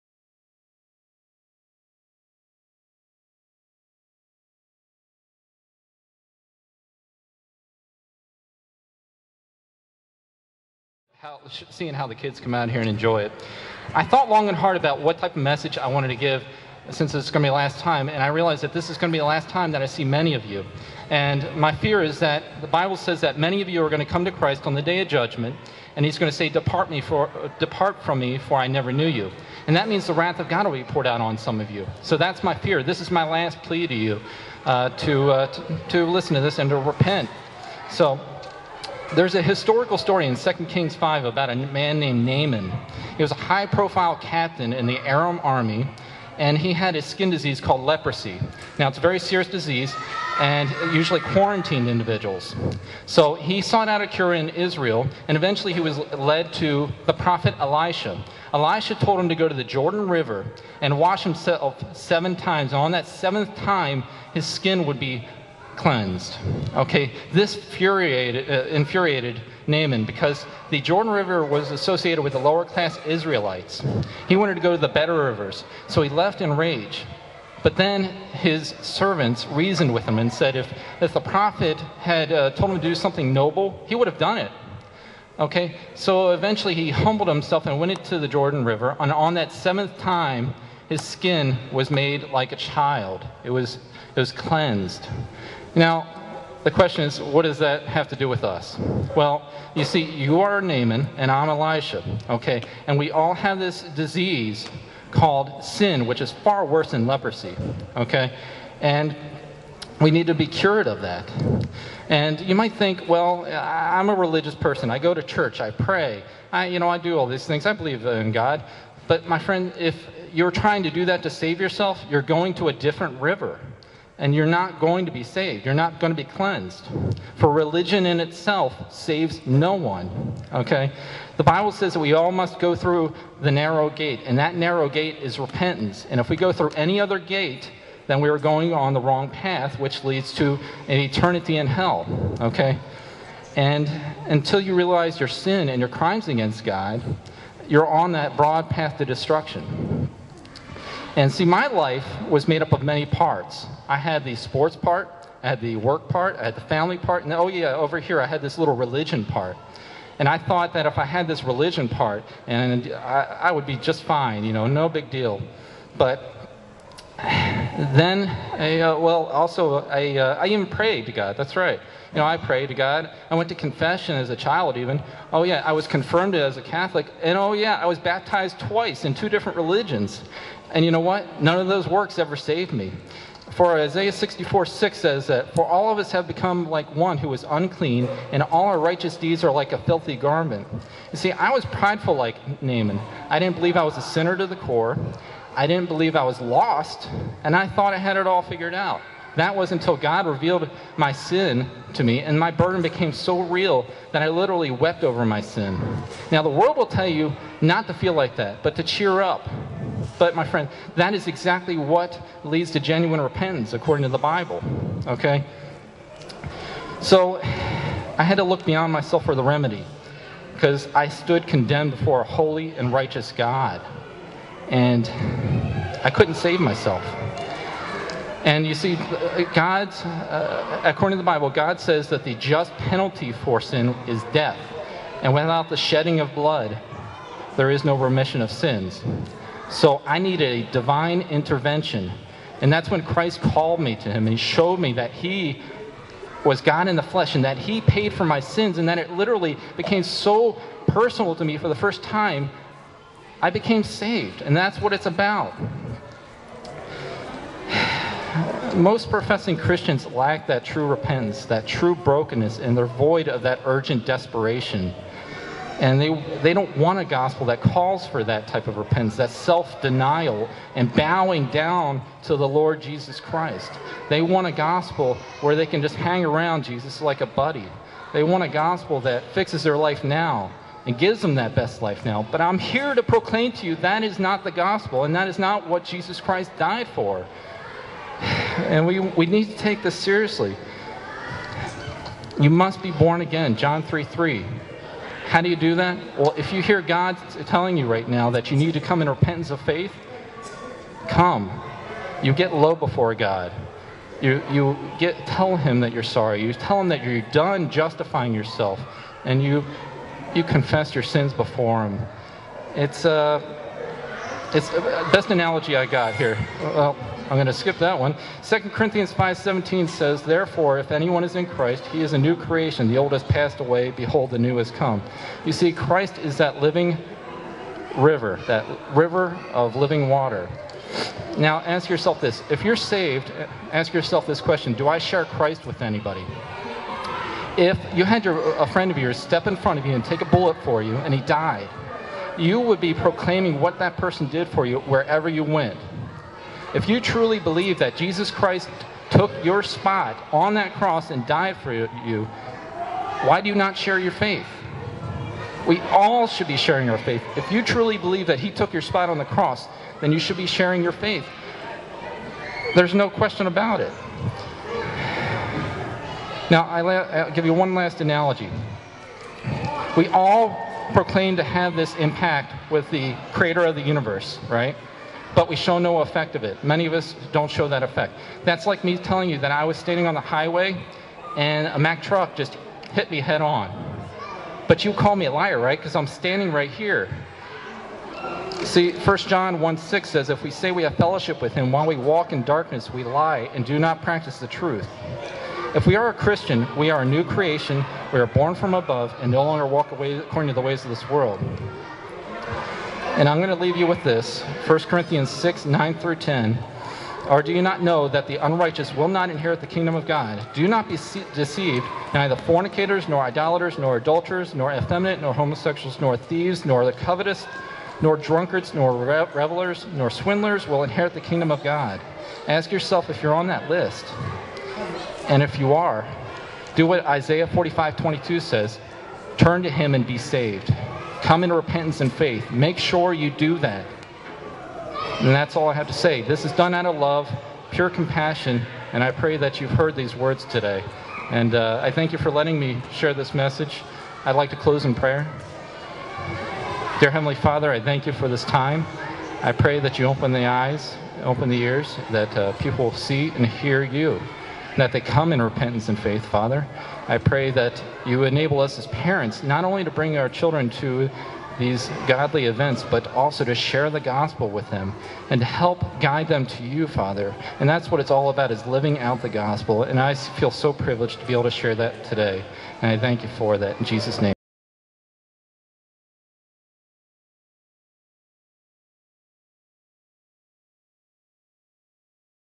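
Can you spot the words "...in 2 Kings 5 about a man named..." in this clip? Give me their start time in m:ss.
0:40.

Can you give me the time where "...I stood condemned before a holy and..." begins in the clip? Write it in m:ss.
3:40.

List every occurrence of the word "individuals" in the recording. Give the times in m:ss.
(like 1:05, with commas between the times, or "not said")
0:51.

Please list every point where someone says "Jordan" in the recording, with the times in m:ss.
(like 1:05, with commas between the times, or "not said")
0:59, 1:10, 1:28.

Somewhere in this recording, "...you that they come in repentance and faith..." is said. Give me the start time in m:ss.
7:33.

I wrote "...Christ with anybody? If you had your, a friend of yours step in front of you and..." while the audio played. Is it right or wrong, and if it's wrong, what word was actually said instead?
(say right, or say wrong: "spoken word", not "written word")
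right.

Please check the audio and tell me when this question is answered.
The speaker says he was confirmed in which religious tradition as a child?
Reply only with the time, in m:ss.
2:56.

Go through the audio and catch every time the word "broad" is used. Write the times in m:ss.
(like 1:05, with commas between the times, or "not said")
2:28.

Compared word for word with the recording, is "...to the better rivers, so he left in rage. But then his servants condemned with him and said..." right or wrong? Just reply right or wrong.
wrong.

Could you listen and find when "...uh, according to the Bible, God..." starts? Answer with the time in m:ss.
3:50.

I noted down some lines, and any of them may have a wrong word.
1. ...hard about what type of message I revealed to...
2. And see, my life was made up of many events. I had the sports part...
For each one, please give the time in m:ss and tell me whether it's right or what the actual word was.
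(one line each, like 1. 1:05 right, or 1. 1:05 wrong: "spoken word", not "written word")
1. 0:14 wrong: "wanted", not "revealed"
2. 2:31 wrong: "parts", not "events".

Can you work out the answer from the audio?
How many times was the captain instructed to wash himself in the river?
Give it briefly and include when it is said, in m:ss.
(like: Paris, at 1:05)
7, at 1:01.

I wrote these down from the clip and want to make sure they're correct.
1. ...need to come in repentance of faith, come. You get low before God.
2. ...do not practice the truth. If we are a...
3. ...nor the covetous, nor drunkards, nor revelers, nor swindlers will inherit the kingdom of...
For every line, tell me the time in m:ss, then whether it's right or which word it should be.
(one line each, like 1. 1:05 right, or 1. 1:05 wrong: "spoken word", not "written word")
1. 4:58 right
2. 6:33 right
3. 6:56 right.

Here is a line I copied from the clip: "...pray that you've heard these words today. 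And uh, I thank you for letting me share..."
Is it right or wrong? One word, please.
right.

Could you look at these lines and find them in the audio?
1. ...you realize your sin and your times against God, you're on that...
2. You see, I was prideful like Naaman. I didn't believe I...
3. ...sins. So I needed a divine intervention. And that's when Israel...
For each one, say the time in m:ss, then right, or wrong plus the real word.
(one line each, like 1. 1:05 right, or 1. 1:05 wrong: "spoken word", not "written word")
1. 2:24 wrong: "crimes", not "times"
2. 3:11 right
3. 3:58 wrong: "Christ", not "Israel".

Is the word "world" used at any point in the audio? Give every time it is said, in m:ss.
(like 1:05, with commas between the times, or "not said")
3:26, 6:41.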